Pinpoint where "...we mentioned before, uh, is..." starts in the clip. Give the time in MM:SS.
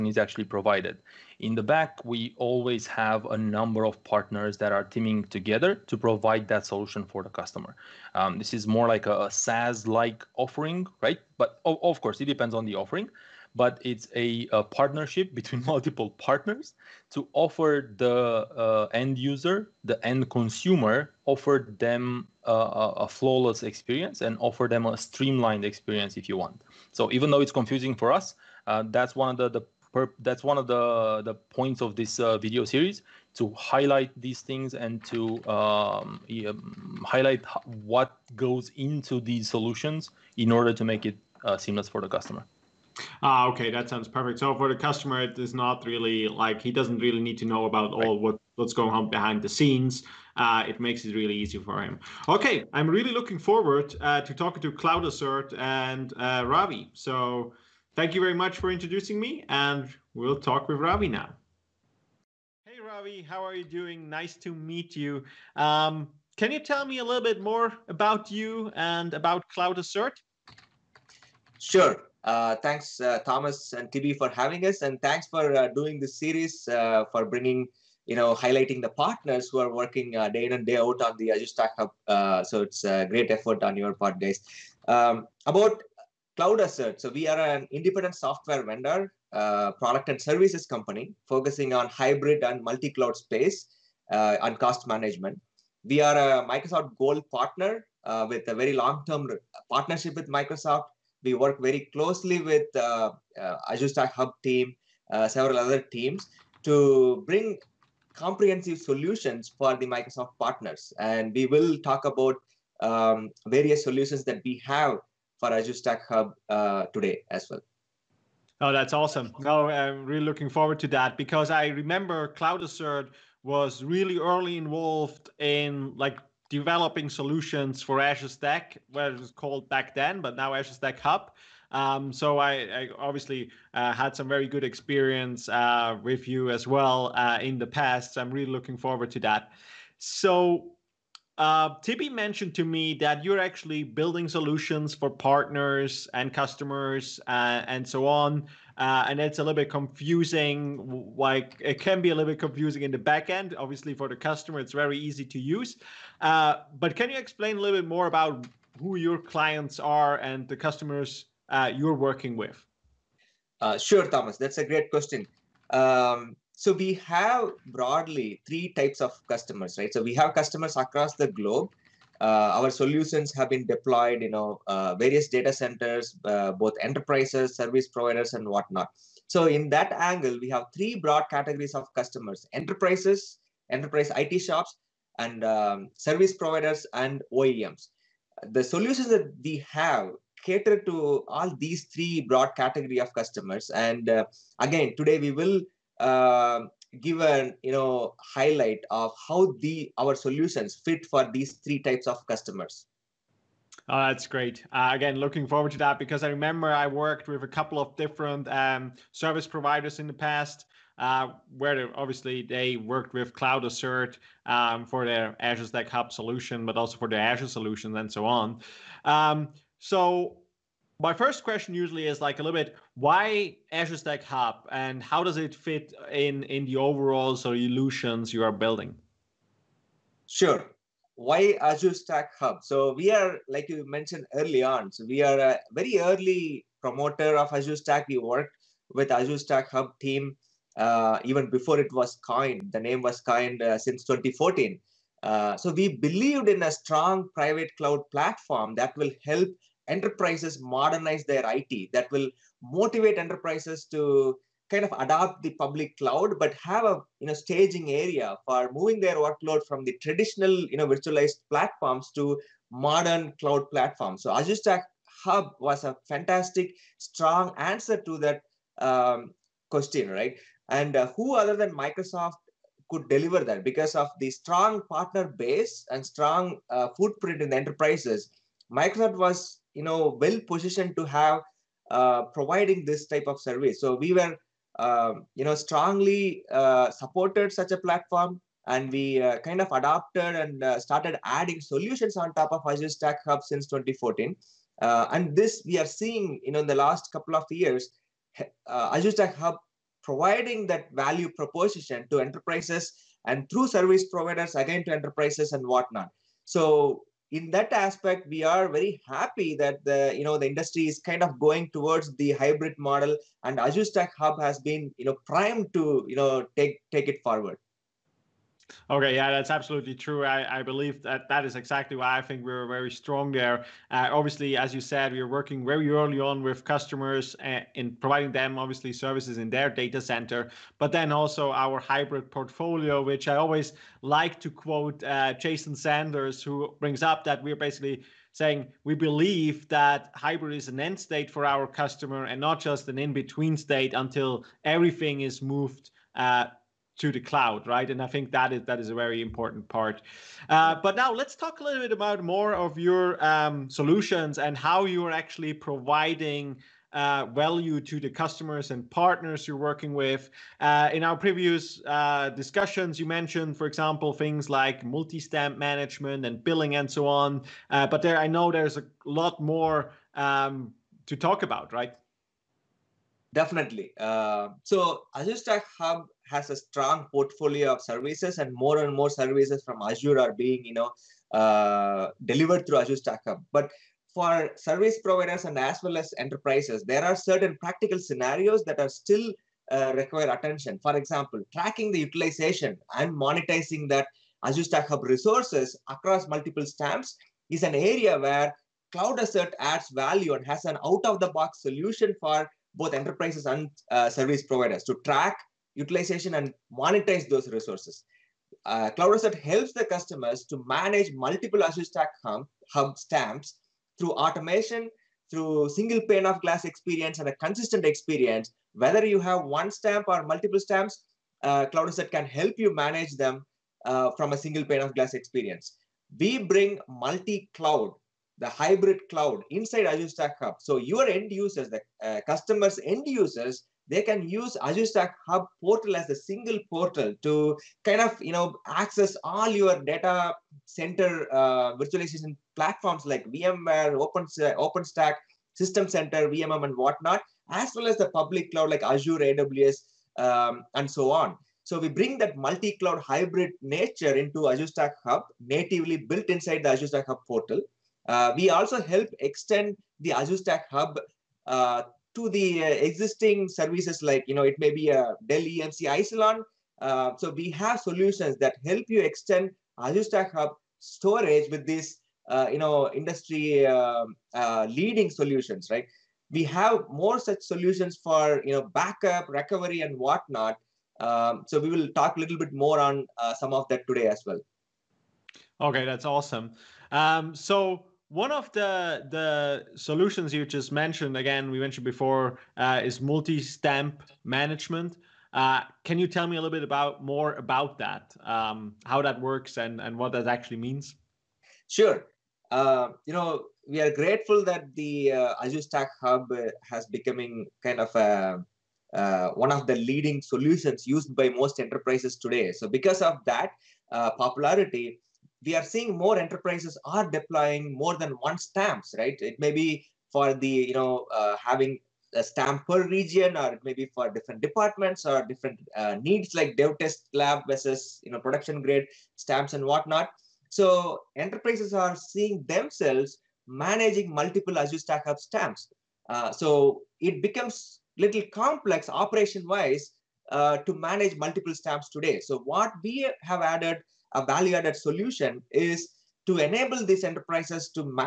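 08:11.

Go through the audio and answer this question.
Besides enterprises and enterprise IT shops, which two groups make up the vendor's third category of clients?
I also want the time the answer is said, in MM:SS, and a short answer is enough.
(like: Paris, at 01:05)
service providers and OEMs, at 03:05.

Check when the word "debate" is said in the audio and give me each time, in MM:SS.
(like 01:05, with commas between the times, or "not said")
not said.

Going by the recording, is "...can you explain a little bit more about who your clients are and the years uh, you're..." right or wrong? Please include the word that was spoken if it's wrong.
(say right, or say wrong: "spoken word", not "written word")
wrong: "customers", not "years".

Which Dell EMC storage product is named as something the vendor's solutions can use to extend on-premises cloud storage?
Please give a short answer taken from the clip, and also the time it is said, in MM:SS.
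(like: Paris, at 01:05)
Isilon, at 07:45.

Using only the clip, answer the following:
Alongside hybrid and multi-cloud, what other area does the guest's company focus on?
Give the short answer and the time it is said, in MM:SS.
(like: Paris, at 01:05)
cost management, at 01:34.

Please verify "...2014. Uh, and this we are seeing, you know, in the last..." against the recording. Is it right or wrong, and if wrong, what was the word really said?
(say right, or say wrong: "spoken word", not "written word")
right.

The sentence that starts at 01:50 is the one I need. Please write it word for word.
And we will talk about um, various solutions that we have for Azure Stack Hub uh, today as well.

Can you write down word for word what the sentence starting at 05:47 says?
And I think that is that is a very important part.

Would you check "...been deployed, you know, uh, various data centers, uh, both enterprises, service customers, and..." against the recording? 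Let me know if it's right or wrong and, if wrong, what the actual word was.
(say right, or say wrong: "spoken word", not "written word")
wrong: "providers", not "customers".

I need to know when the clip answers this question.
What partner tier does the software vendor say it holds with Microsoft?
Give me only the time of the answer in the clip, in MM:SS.
01:36.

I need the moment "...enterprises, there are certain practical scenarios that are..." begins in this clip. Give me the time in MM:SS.
06:26.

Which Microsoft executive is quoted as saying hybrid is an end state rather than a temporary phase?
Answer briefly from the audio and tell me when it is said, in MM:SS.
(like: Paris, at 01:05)
Jason Zander, at 05:35.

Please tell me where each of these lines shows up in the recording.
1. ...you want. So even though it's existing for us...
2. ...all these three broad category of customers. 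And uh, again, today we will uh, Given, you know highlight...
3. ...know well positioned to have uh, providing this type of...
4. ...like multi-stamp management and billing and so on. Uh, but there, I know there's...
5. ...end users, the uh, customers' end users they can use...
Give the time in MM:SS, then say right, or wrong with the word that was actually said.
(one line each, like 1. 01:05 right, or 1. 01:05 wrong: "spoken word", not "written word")
1. 00:26 wrong: "confusing", not "existing"
2. 03:11 right
3. 04:39 right
4. 06:04 right
5. 07:11 right.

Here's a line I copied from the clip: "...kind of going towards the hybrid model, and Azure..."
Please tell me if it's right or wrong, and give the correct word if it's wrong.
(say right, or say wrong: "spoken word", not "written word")
right.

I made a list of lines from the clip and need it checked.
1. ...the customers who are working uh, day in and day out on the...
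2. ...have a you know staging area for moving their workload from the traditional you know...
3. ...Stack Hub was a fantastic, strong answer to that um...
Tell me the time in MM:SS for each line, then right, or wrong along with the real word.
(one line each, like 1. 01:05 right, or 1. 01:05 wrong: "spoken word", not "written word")
1. 01:18 wrong: "partners", not "customers"
2. 04:16 right
3. 04:24 right.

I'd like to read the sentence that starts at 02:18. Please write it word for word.
So I'm really looking forward to that.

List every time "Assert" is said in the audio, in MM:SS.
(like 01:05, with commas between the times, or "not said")
00:55, 01:09, 01:26, 02:02, 03:33, 06:39, 06:49, 07:01.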